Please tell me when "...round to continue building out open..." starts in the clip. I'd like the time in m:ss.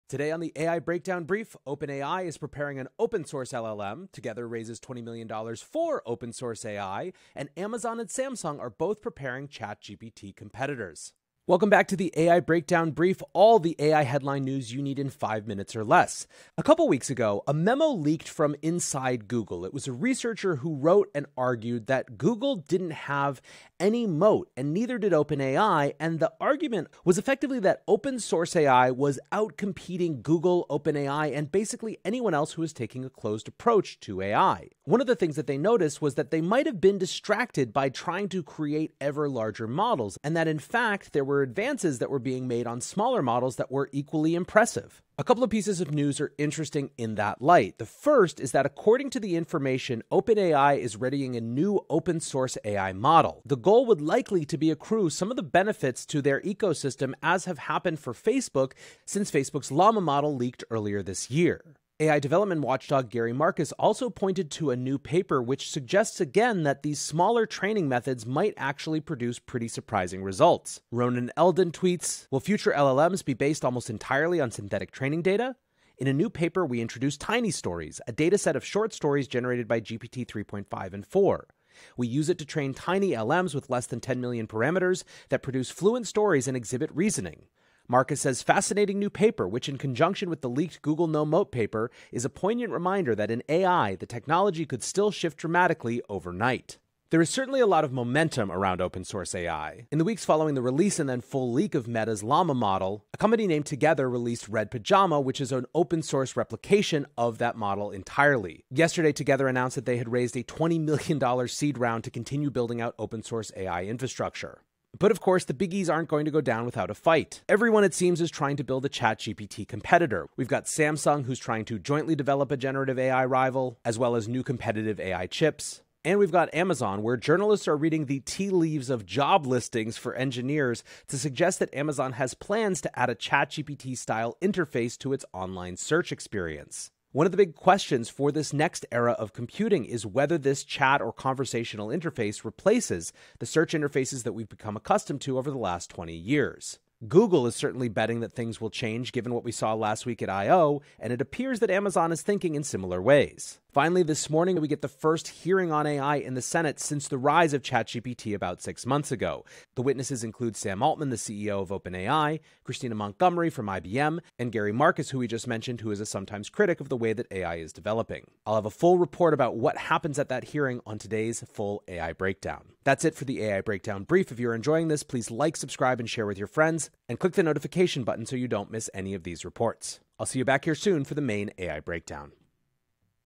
1:51.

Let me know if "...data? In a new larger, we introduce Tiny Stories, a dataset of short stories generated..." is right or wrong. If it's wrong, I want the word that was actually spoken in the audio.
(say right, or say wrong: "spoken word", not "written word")
wrong: "paper", not "larger".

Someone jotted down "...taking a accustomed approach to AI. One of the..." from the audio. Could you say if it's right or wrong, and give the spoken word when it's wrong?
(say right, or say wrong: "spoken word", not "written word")
wrong: "closed", not "accustomed".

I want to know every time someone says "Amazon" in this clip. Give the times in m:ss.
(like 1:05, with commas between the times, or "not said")
0:07, 2:06, 2:11, 2:31.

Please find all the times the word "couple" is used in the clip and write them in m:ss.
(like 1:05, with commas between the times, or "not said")
0:16, 0:45.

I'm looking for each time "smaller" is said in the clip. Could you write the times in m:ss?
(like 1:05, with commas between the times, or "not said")
0:42, 1:06.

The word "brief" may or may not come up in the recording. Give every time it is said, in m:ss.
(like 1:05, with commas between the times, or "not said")
0:01, 0:12, 2:54.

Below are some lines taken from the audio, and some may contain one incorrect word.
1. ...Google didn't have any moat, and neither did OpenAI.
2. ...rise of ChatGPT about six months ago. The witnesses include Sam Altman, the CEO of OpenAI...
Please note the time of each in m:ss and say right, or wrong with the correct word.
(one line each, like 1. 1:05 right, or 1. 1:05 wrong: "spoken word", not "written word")
1. 0:22 right
2. 2:37 right.